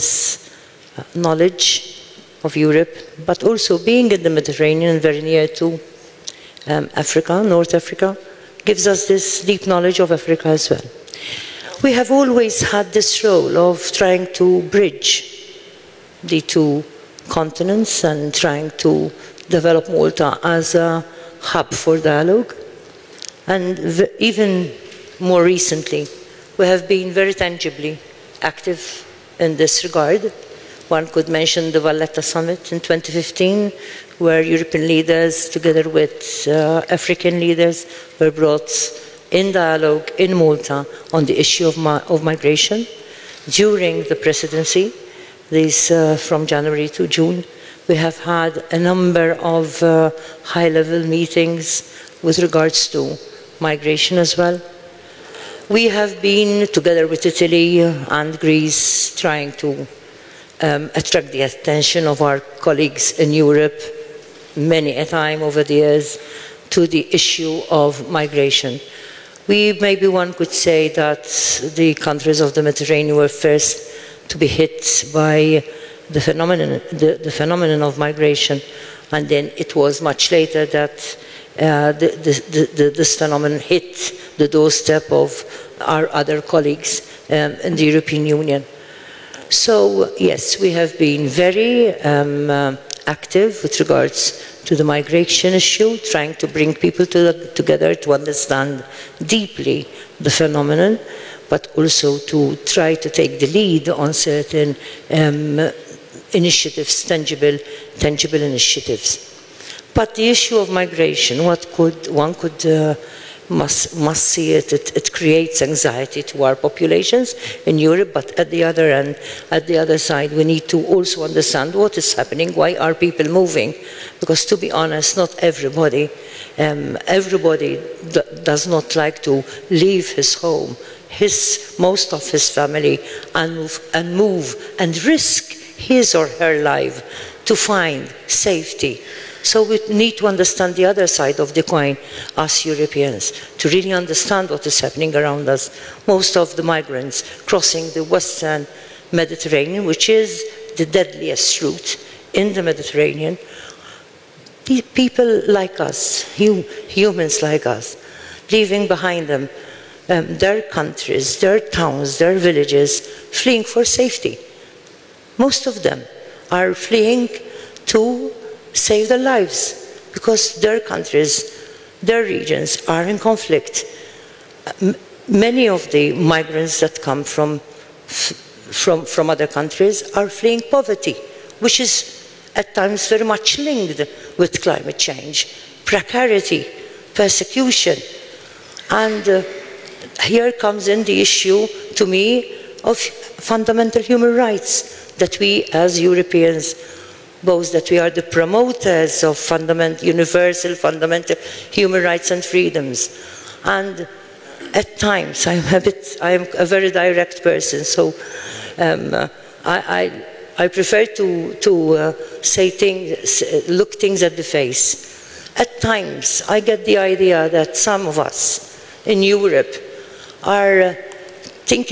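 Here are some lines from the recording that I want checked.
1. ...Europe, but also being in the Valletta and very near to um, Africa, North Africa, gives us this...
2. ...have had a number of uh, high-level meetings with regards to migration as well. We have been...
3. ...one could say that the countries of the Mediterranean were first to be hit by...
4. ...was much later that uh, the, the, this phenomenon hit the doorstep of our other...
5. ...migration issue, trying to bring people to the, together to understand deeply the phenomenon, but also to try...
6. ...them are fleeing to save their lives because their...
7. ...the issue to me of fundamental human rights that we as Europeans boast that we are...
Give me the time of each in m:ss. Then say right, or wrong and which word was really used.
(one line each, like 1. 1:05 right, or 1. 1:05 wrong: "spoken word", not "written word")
1. 0:02 wrong: "Mediterranean", not "Valletta"
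2. 0:47 right
3. 1:10 right
4. 1:19 right
5. 1:34 right
6. 2:45 right
7. 3:11 right.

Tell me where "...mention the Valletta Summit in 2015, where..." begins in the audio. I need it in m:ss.
0:31.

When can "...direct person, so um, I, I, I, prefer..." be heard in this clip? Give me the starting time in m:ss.
3:26.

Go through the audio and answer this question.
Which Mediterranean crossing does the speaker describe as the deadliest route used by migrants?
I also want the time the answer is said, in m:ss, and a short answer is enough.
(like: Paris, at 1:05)
western Mediterranean, at 2:28.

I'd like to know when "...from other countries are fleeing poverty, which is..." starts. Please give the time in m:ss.
2:59.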